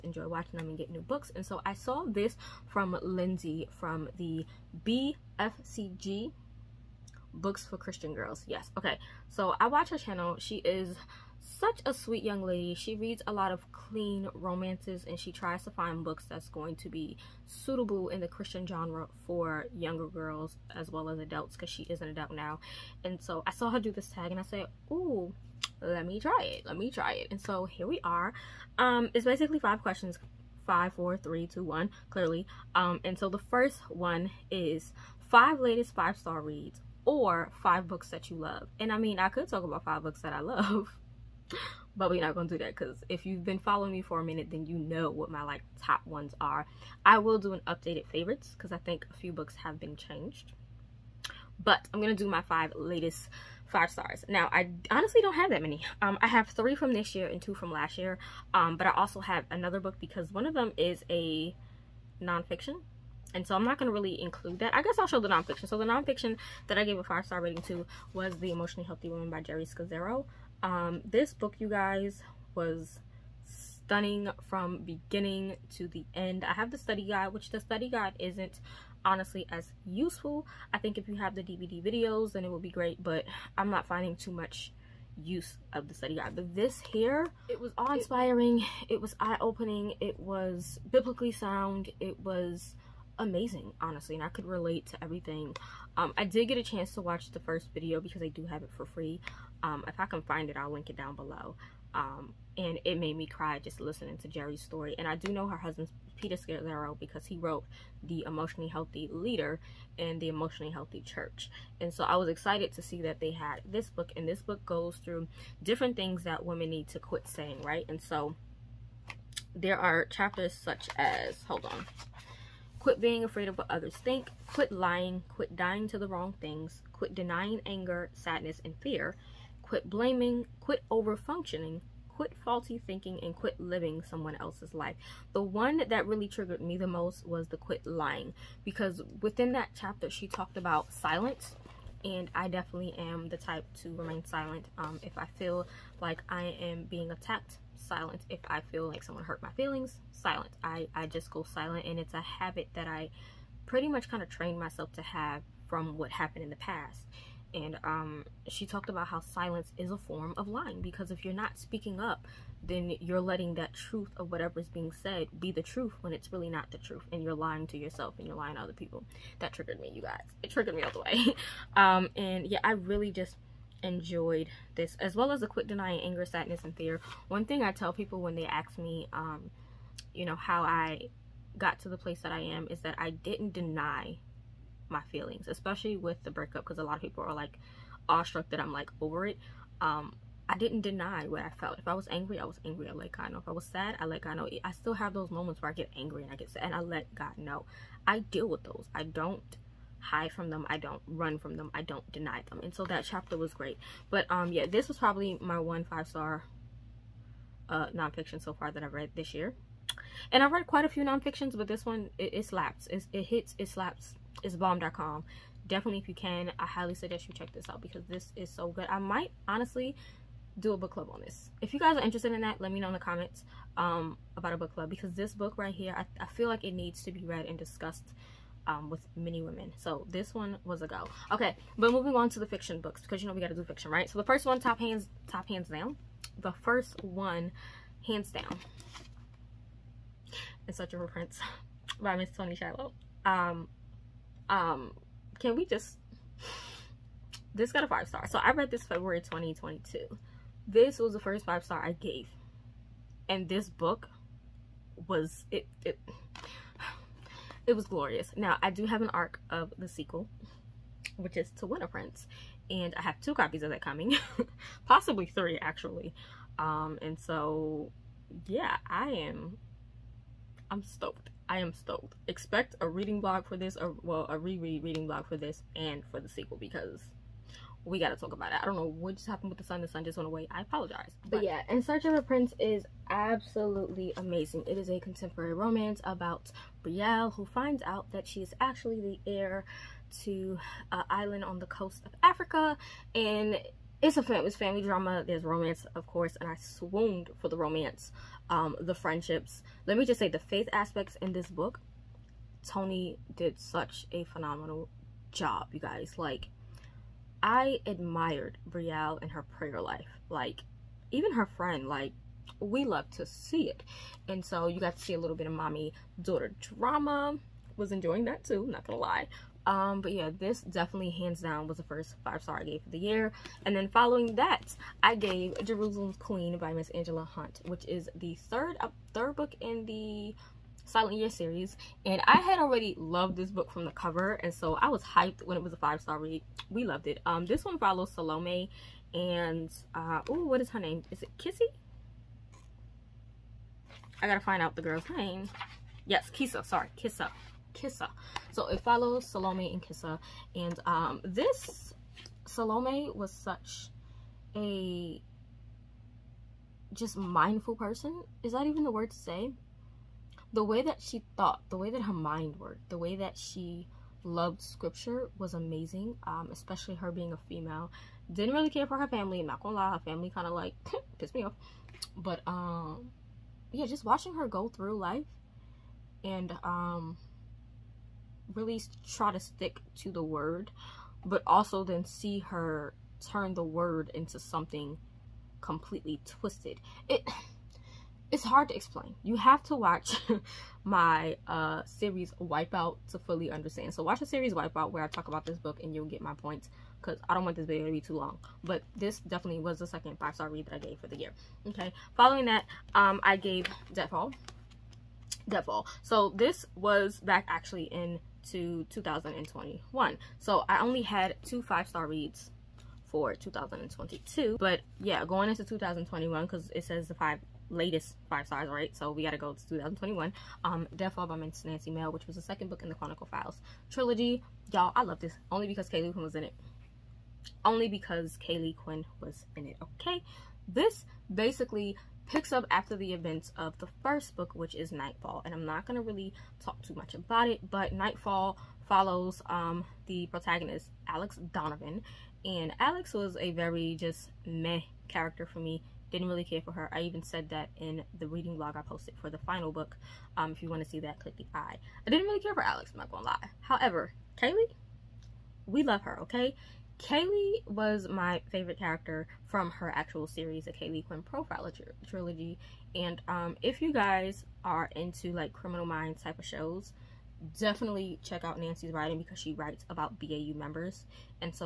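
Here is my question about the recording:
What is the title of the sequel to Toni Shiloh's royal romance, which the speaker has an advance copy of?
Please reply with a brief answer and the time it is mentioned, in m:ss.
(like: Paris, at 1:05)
To Win a Prince, at 4:21.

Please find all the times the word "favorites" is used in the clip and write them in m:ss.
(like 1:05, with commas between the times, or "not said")
0:48, 7:38.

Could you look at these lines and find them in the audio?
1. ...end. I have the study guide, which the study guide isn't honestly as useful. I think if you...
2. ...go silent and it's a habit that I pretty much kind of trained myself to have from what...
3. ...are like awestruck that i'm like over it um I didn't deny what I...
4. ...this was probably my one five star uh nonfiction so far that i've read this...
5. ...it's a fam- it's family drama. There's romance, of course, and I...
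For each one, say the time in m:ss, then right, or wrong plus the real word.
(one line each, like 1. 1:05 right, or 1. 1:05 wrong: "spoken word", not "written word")
1. 1:16 right
2. 2:31 right
3. 3:07 right
4. 3:24 right
5. 4:54 right.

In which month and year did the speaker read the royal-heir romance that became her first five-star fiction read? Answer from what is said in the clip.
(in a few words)
February 2022.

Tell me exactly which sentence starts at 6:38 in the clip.
But this definitely was the second five-star read that I gave for the year.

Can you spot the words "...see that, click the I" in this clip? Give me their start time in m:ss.
7:30.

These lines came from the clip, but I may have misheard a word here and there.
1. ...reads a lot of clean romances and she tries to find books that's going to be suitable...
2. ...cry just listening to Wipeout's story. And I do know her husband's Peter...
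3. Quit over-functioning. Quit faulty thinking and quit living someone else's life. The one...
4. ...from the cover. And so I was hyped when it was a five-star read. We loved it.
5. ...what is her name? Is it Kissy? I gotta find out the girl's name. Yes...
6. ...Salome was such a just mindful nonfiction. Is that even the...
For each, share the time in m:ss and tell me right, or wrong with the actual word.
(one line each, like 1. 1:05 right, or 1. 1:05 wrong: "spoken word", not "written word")
1. 0:12 right
2. 1:43 wrong: "Geri", not "Wipeout"
3. 2:10 right
4. 5:33 right
5. 5:40 right
6. 5:52 wrong: "person", not "nonfiction".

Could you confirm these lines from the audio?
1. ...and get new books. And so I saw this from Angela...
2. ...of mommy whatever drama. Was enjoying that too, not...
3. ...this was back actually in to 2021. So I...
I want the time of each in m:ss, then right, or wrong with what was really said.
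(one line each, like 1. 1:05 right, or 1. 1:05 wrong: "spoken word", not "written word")
1. 0:00 wrong: "Lindsey", not "Angela"
2. 5:15 wrong: "daughter", not "whatever"
3. 6:46 right.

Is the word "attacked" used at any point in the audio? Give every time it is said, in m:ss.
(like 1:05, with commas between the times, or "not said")
2:27.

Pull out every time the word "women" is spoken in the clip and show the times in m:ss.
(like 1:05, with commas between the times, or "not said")
1:56, 3:49.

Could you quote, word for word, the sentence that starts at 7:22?
And Alex was a very just meh character for me didn't really care for her.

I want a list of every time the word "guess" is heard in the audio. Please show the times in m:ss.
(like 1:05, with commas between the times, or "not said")
1:04.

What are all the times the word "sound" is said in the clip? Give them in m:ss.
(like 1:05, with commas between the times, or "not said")
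1:31.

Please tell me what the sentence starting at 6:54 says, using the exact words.
But yeah, going into 2021 because it says the five latest five stars, right?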